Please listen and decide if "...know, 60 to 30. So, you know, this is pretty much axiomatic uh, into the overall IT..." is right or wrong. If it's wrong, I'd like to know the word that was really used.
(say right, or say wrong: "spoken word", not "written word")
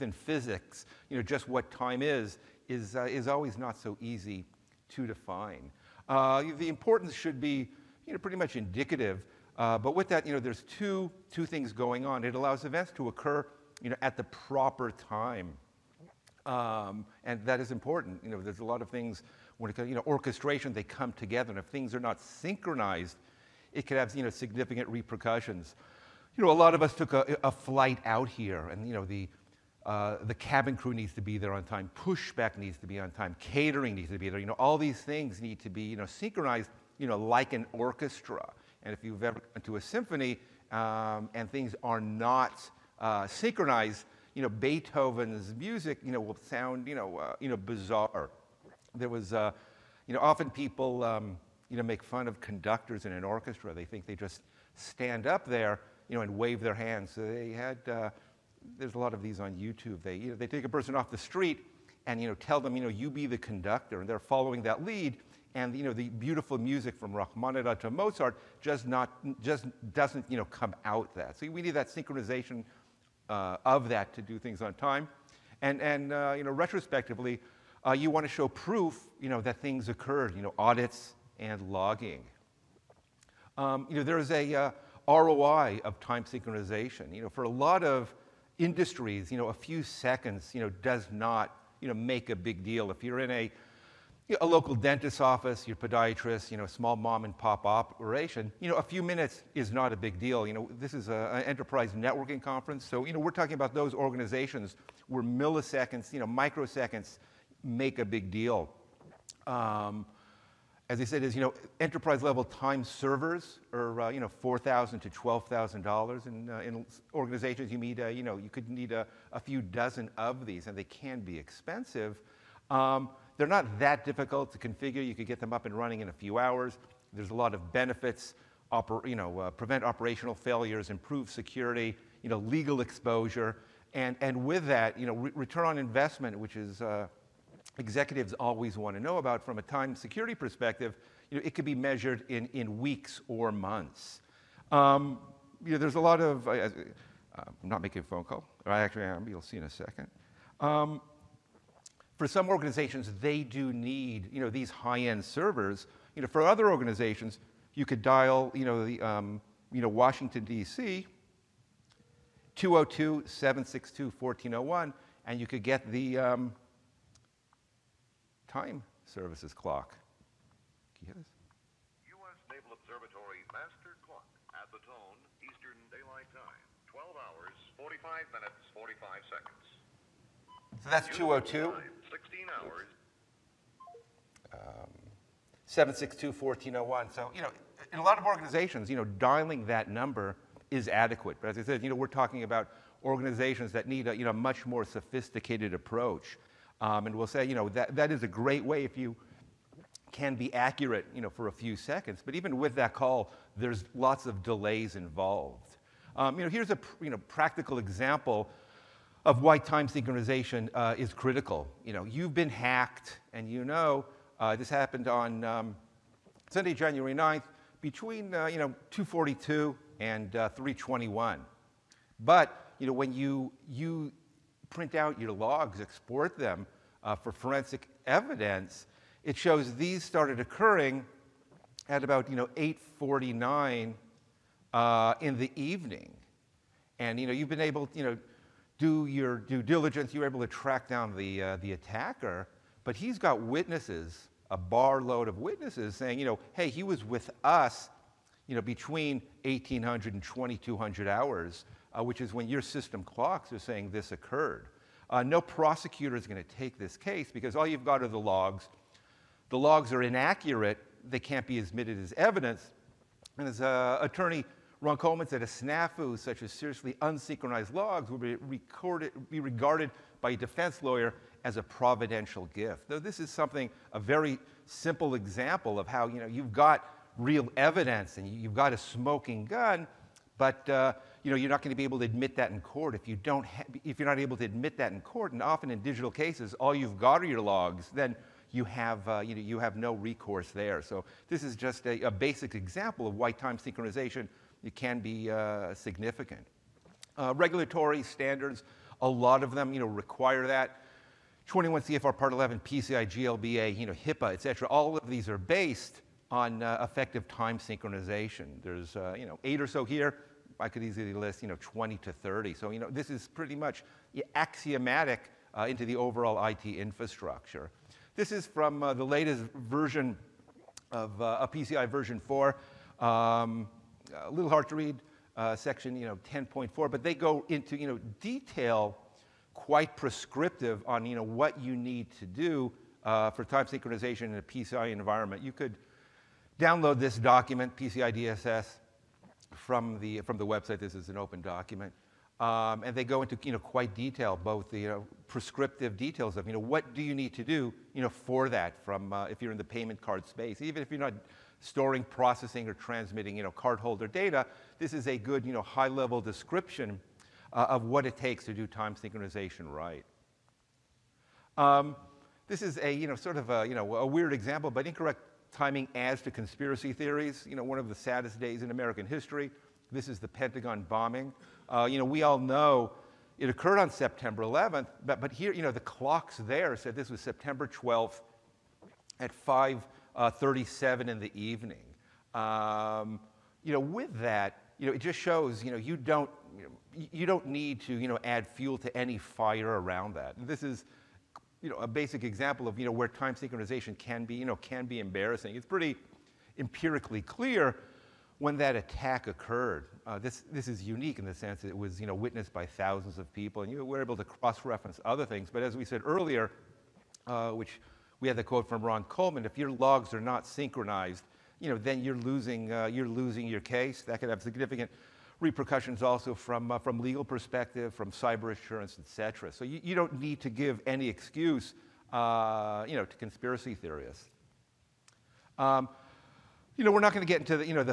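wrong: "20", not "60".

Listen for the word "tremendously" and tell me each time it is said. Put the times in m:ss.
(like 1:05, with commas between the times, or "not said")
not said.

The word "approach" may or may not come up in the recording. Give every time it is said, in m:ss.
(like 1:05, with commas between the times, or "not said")
3:15.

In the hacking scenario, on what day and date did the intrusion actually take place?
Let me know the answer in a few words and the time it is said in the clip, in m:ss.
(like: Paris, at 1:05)
Sunday, January 9th, at 3:36.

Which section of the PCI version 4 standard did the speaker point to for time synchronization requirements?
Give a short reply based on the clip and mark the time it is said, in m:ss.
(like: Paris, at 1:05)
10.4, at 5:26.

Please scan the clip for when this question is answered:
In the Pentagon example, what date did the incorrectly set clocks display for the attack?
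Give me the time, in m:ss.
6:17.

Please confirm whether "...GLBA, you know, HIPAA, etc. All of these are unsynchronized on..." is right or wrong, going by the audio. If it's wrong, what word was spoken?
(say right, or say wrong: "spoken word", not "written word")
wrong: "based", not "unsynchronized".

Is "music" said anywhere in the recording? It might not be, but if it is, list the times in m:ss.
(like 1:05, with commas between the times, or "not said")
0:45, 1:06.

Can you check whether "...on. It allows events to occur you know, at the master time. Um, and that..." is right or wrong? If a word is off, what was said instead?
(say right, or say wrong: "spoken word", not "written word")
wrong: "proper", not "master".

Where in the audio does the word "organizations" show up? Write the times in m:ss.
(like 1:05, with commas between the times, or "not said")
1:43, 1:57, 2:32, 2:36, 3:08, 3:13.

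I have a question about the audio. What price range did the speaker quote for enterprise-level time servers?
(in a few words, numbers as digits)
$4,000 to $12,000.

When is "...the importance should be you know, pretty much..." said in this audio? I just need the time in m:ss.
0:06.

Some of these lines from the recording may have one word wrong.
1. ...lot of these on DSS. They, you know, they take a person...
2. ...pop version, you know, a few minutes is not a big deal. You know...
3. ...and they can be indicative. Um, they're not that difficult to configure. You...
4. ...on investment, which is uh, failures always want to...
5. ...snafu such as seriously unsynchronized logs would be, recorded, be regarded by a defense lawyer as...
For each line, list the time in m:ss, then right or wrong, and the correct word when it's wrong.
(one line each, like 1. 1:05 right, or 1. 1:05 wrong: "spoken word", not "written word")
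1. 0:58 wrong: "YouTube", not "DSS"
2. 1:37 wrong: "operation", not "version"
3. 2:00 wrong: "expensive", not "indicative"
4. 2:15 wrong: "executives", not "failures"
5. 4:25 right.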